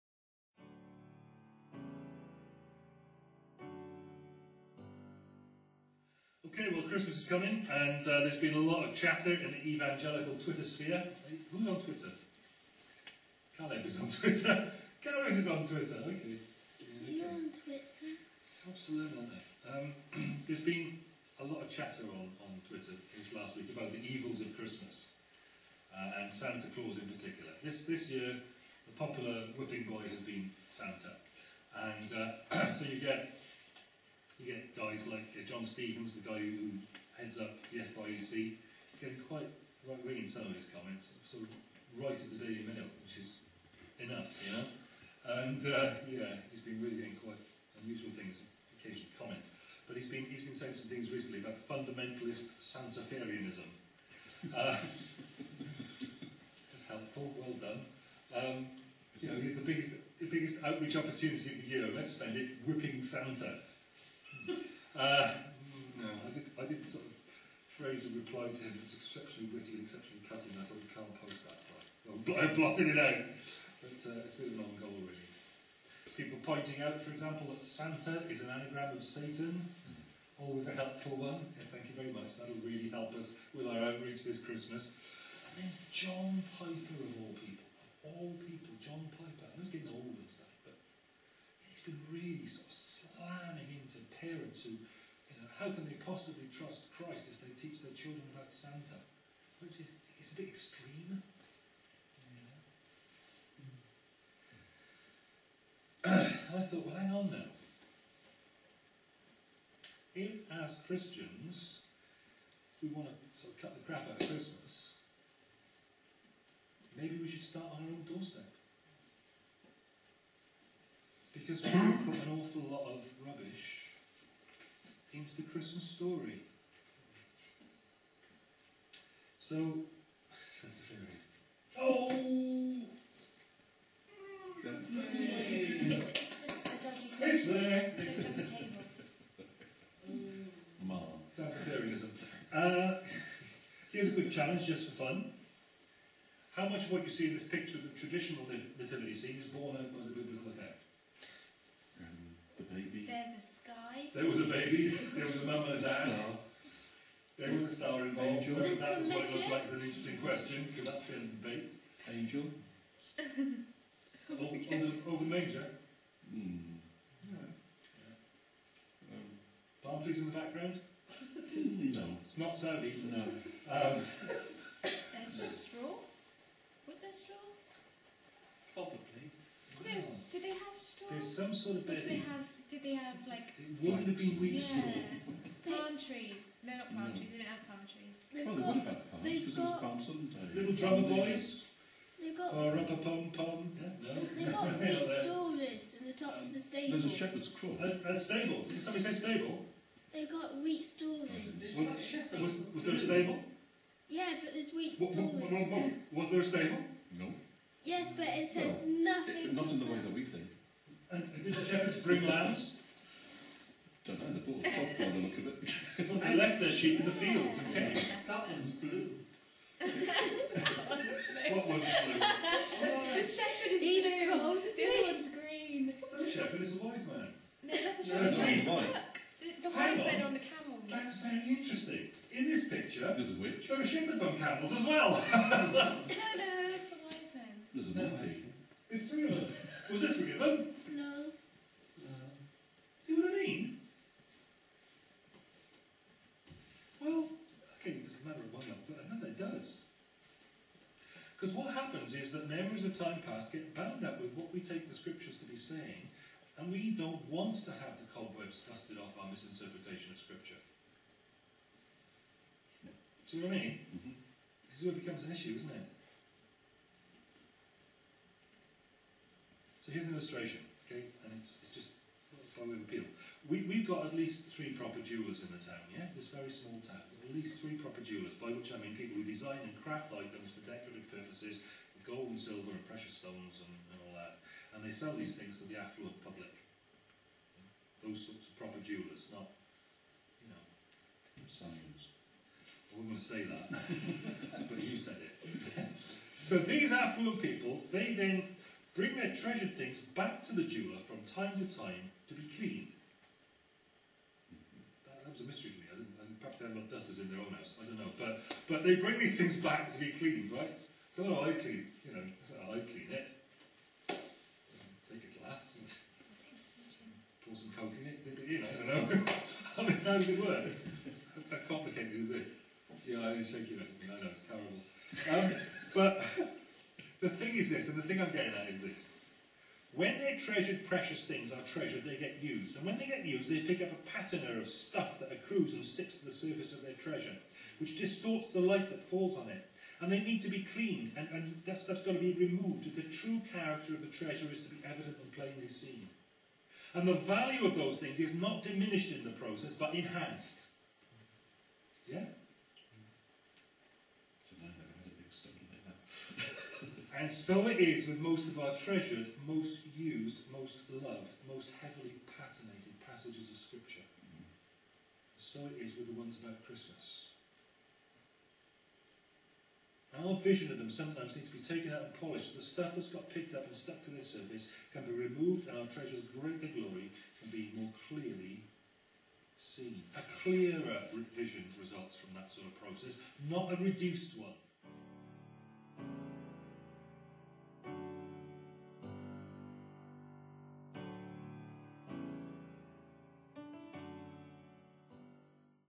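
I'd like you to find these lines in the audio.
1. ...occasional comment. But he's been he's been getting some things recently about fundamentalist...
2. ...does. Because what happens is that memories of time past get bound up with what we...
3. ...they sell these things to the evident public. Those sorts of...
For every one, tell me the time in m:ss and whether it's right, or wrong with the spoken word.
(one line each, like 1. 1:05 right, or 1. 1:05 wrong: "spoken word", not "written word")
1. 0:48 wrong: "saying", not "getting"
2. 4:09 right
3. 4:44 wrong: "affluent", not "evident".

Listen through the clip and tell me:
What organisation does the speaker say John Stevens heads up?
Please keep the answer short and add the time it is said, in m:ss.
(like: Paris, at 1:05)
FIEC, at 0:37.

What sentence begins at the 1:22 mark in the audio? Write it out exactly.
That'll really help us with our outreach this Christmas.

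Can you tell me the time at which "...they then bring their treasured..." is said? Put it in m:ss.
4:57.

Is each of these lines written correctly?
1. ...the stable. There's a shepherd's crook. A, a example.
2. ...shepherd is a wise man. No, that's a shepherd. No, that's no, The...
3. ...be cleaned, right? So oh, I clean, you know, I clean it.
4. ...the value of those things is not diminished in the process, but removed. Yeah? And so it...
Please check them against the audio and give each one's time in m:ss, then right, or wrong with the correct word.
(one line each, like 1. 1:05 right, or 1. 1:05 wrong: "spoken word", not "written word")
1. 3:16 wrong: "stable", not "example"
2. 3:46 right
3. 5:09 right
4. 5:47 wrong: "enhanced", not "removed".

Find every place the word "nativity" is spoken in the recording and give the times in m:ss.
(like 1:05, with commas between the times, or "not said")
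2:28.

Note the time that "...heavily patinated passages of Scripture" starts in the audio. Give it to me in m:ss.
6:01.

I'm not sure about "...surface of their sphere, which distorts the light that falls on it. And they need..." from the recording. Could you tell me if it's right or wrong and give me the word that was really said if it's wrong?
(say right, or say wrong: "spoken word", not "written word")
wrong: "treasure", not "sphere".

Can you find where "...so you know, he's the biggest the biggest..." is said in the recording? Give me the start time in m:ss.
0:59.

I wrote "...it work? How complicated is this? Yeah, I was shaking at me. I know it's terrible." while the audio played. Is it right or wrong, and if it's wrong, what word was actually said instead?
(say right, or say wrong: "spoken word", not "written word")
right.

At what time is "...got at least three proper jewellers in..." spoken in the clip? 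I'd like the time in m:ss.
4:33.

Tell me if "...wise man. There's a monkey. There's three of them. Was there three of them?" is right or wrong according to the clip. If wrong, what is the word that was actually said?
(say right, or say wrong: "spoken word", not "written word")
right.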